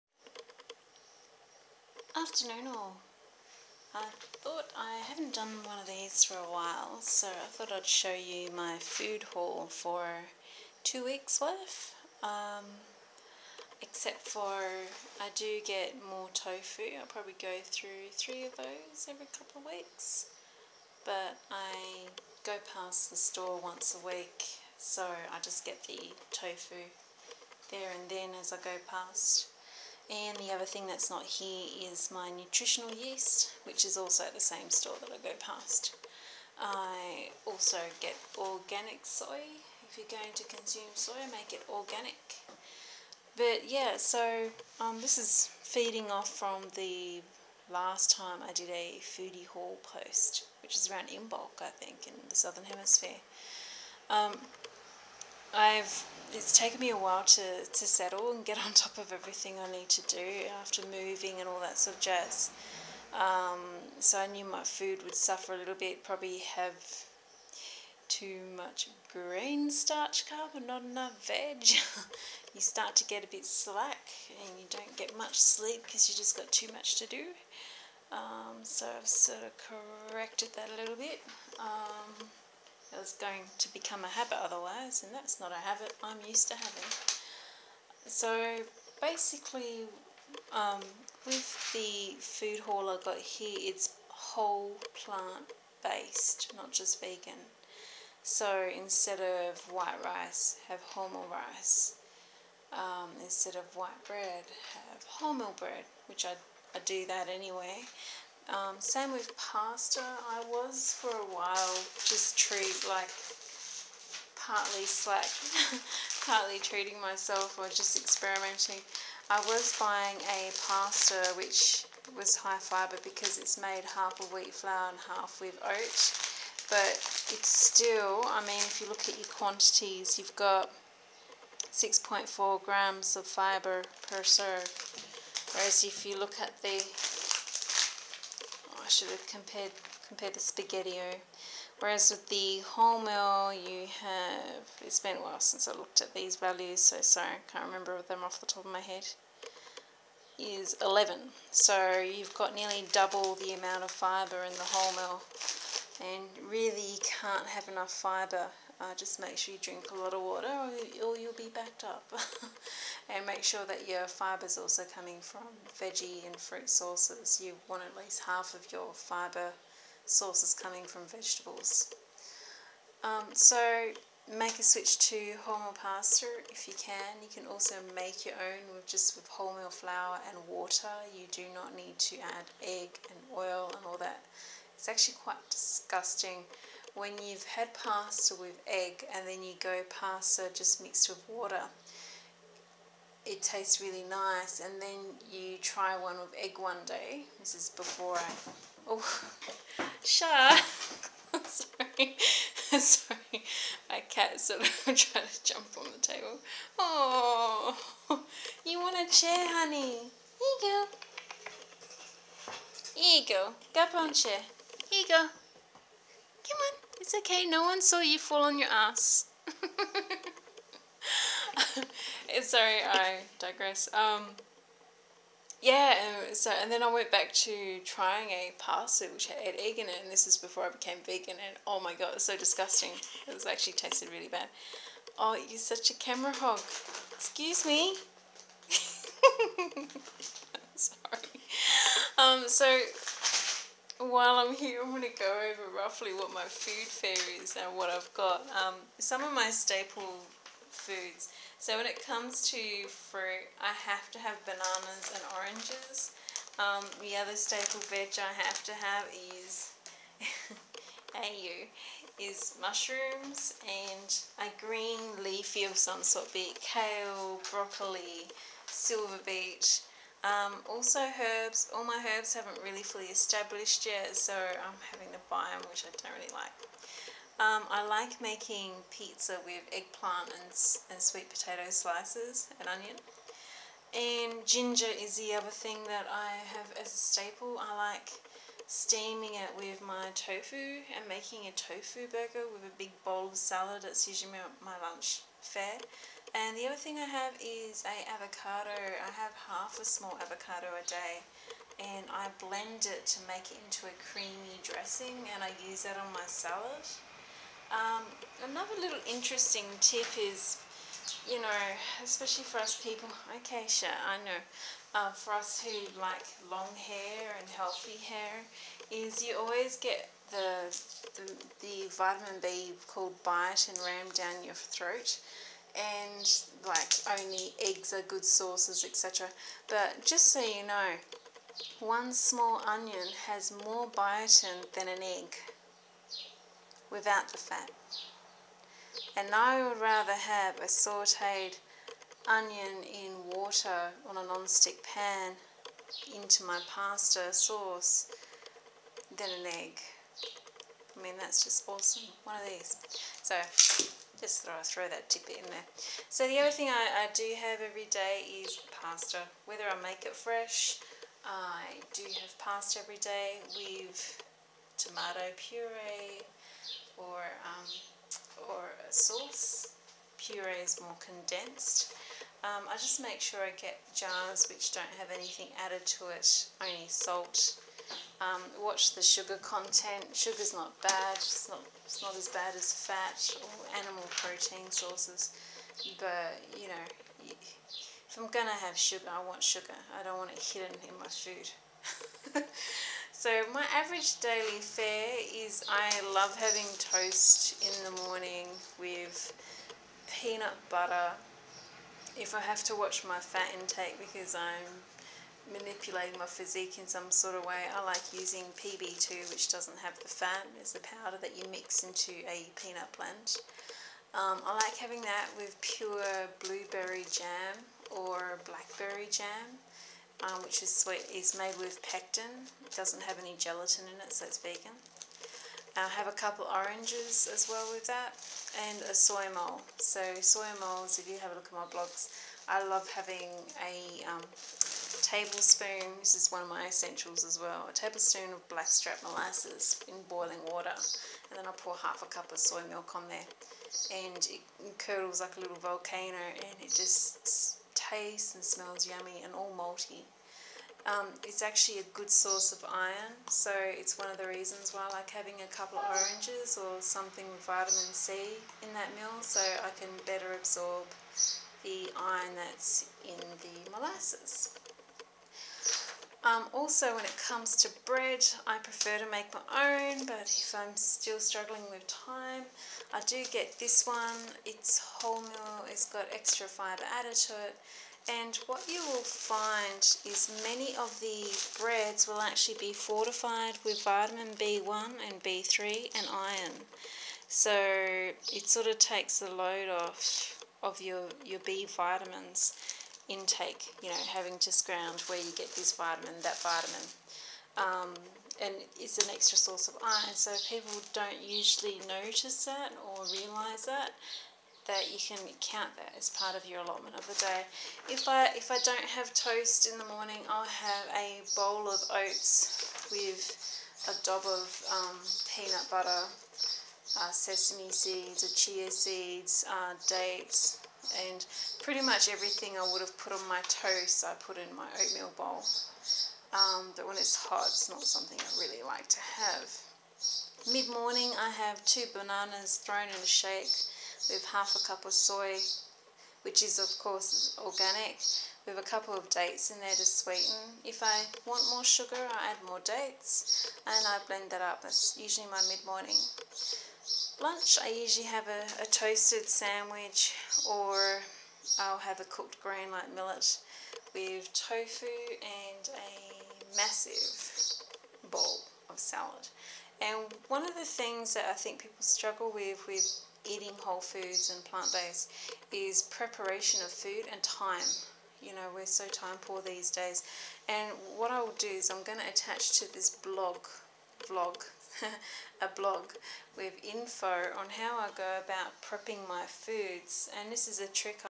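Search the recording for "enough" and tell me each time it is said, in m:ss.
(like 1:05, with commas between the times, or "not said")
1:10, 2:37.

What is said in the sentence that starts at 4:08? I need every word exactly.
Um, some of my staple foods.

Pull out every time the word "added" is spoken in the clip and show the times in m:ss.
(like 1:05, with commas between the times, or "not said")
6:15, 7:56.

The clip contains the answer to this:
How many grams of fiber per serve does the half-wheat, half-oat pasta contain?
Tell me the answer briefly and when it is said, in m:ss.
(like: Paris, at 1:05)
6.4 grams, at 2:11.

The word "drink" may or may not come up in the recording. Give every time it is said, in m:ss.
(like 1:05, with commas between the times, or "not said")
2:39.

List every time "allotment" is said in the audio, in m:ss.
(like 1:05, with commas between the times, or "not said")
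8:26.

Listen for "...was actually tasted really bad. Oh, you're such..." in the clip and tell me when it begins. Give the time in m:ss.
3:53.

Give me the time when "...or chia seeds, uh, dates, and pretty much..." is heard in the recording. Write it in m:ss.
8:38.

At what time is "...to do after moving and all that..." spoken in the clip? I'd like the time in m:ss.
0:59.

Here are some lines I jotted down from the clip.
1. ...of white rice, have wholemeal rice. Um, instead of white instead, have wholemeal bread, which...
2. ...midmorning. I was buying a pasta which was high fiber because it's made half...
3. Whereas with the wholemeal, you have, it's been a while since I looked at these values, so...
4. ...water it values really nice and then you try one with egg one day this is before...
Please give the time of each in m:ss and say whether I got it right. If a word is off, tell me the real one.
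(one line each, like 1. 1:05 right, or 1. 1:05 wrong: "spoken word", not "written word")
1. 1:39 wrong: "bread", not "instead"
2. 1:57 wrong: "experimenting", not "midmorning"
3. 2:21 right
4. 3:11 wrong: "tastes", not "values".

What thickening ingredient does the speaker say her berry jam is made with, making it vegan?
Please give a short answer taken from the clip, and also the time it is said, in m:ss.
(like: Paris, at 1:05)
pectin, at 7:01.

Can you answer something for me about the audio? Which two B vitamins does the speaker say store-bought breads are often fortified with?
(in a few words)
B1 and B3.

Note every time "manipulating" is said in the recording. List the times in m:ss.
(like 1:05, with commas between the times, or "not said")
6:45.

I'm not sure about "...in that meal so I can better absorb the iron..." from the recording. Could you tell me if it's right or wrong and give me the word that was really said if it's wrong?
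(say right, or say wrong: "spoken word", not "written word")
right.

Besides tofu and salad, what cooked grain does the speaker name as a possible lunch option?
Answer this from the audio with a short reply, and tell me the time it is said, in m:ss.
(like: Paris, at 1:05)
millet, at 9:12.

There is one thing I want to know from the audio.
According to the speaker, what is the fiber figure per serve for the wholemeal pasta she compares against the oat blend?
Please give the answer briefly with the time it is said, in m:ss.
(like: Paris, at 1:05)
11, at 2:30.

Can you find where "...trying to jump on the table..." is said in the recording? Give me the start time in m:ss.
3:24.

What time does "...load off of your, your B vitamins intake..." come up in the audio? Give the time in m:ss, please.
8:09.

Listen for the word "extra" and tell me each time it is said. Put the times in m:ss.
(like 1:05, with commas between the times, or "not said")
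7:56, 8:19.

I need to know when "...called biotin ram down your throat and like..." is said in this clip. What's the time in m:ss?
5:22.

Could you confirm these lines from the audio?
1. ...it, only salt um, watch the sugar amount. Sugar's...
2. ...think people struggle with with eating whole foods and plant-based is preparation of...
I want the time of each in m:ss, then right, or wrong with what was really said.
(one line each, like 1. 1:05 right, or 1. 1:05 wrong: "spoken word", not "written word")
1. 6:16 wrong: "content", not "amount"
2. 9:21 right.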